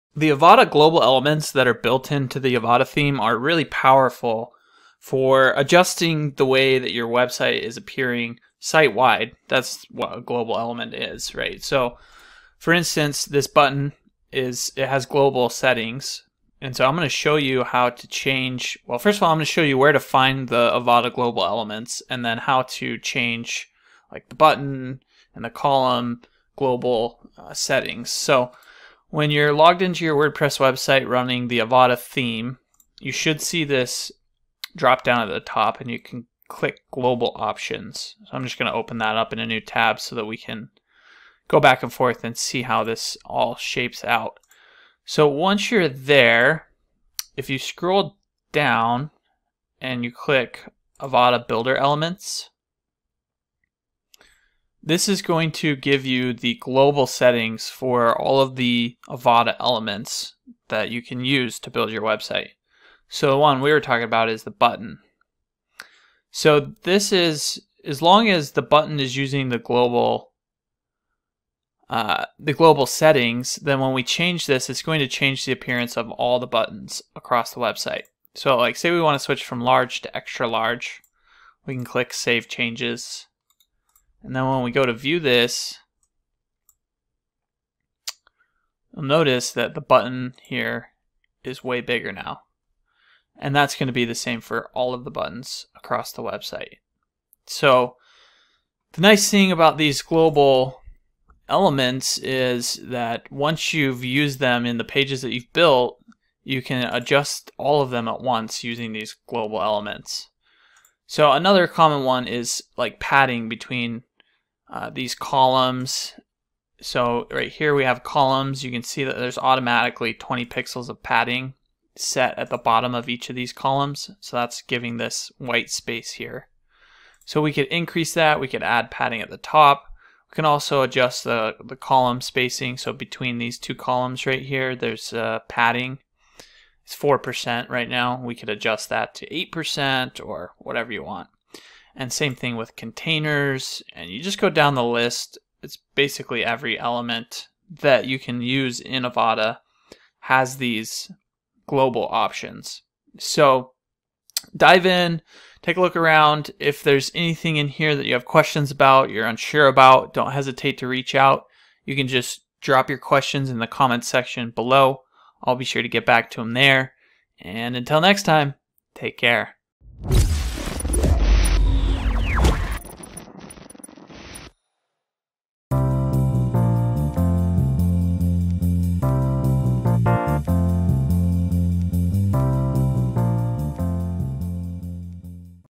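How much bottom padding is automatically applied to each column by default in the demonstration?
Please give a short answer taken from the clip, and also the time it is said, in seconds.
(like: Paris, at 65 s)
20 pixels, at 120 s.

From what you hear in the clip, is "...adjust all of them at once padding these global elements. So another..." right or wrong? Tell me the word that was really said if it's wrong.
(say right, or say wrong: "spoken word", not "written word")
wrong: "using", not "padding".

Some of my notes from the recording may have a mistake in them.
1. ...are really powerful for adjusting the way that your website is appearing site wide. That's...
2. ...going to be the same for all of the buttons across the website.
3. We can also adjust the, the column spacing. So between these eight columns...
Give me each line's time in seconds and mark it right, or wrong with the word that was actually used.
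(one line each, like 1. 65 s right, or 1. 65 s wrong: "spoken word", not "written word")
1. 3 s right
2. 93 s right
3. 130 s wrong: "two", not "eight".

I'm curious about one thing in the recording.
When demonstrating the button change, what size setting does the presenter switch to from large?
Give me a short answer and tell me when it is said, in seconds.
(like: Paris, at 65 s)
extra large, at 80 s.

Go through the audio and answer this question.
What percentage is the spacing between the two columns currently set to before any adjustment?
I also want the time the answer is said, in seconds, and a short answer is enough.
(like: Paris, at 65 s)
4%, at 136 s.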